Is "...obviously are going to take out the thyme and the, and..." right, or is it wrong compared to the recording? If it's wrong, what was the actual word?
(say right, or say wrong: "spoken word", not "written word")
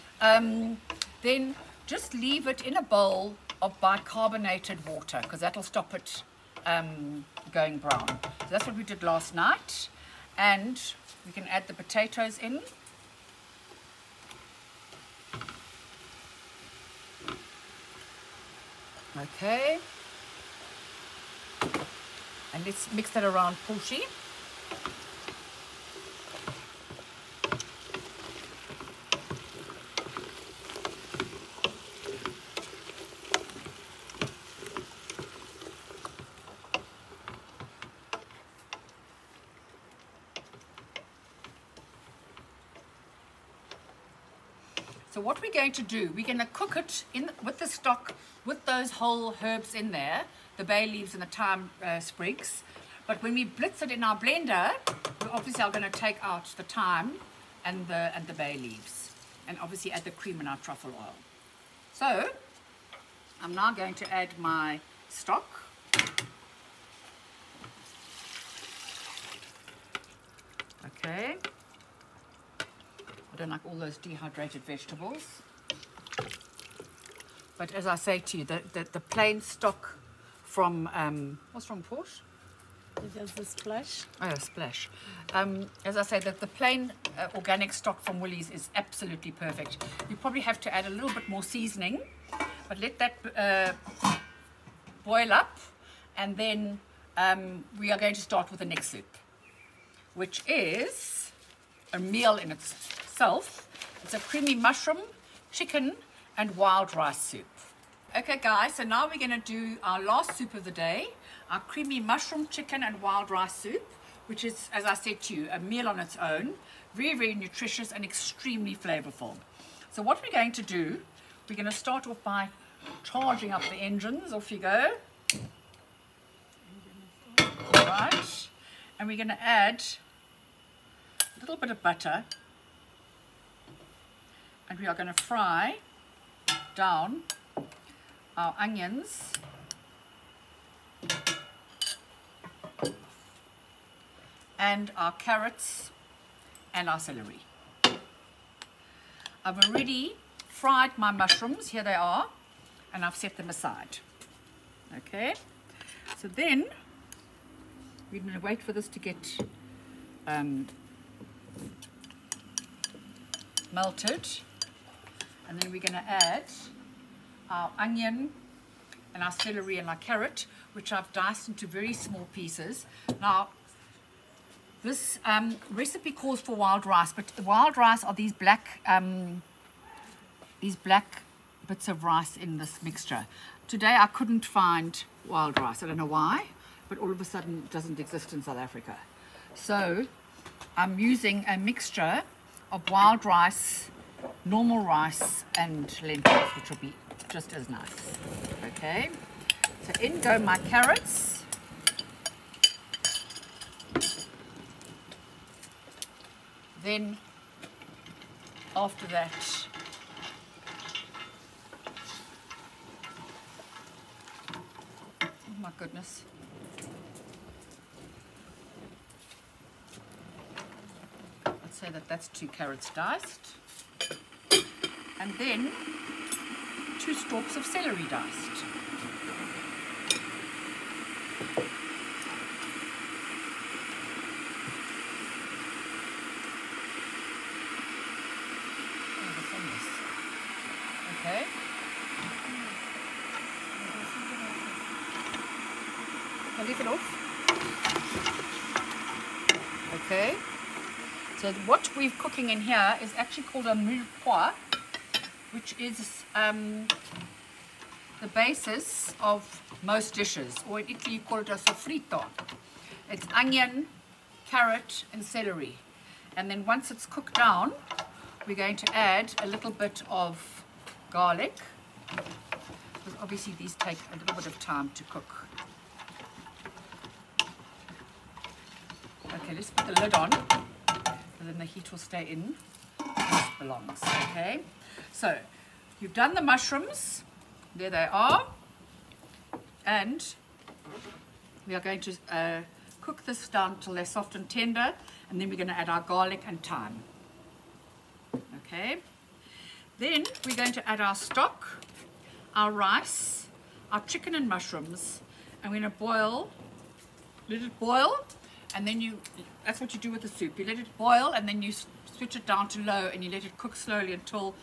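right.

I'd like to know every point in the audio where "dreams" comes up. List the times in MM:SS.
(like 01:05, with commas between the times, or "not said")
not said.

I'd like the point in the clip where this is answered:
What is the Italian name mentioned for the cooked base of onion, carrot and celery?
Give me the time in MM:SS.
04:21.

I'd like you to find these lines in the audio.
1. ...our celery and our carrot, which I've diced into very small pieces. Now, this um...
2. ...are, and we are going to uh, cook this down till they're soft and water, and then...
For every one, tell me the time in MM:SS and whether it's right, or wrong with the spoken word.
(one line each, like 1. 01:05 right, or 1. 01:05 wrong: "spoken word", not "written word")
1. 02:49 right
2. 04:48 wrong: "tender", not "water".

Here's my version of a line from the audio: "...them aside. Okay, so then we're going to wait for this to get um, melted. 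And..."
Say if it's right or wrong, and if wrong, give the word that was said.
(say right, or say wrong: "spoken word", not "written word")
right.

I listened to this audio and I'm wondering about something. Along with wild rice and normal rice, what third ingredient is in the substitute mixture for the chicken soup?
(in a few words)
lentils.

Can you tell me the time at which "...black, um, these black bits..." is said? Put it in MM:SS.
02:58.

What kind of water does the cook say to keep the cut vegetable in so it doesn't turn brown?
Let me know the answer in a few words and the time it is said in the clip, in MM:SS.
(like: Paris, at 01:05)
bicarbonated water, at 00:03.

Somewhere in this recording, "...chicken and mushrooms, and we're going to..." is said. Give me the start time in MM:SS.
05:04.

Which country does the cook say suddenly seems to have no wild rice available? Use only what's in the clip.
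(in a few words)
South Africa.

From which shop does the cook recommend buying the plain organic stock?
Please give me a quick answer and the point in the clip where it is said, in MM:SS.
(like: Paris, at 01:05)
Woolies, at 01:28.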